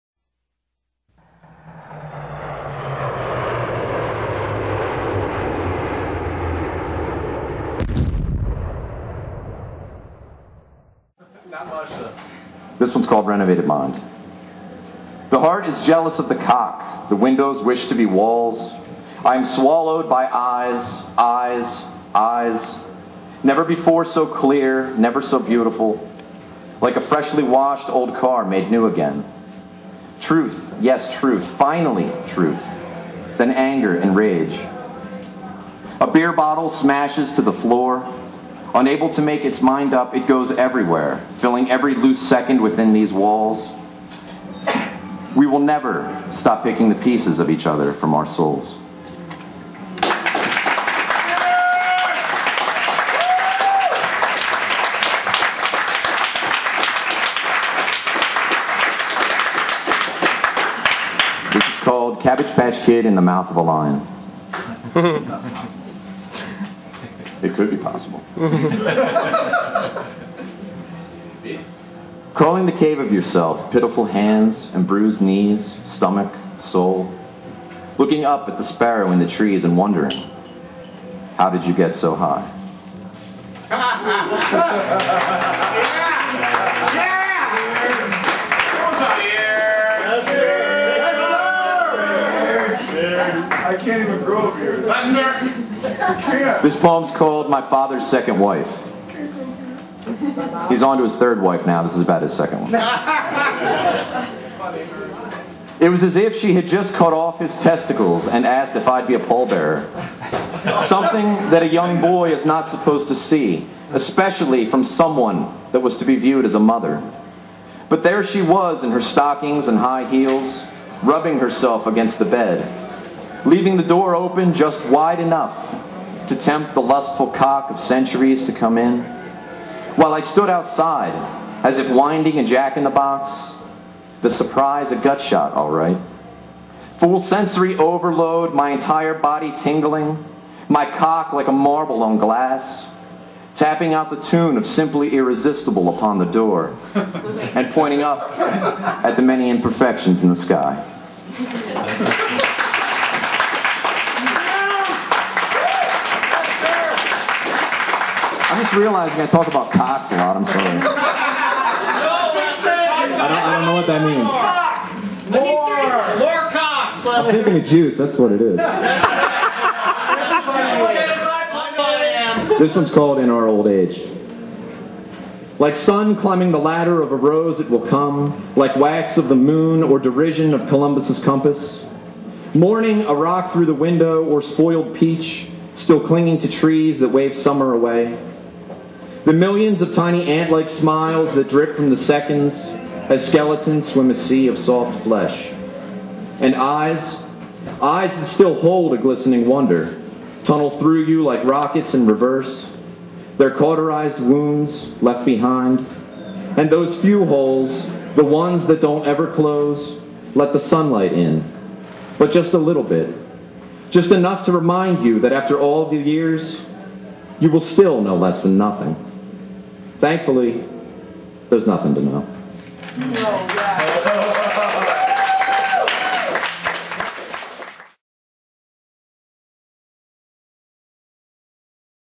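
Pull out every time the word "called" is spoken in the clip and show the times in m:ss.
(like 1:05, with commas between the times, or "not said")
0:13, 1:01, 1:37, 2:52.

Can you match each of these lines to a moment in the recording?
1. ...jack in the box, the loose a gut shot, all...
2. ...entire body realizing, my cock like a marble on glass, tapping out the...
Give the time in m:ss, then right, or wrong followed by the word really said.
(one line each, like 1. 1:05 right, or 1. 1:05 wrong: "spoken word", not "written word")
1. 2:12 wrong: "surprise", not "loose"
2. 2:18 wrong: "tingling", not "realizing".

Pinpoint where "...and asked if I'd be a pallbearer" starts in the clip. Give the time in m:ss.
1:48.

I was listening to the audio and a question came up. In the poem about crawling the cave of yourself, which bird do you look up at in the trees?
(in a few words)
sparrow.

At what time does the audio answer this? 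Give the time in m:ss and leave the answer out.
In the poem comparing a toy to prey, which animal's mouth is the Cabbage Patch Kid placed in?
1:03.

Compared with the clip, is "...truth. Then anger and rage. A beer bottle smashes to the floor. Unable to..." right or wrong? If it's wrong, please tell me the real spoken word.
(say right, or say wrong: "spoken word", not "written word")
right.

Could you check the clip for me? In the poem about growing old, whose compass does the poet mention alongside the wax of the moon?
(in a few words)
Columbus.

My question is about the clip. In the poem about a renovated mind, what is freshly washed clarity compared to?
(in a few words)
old car.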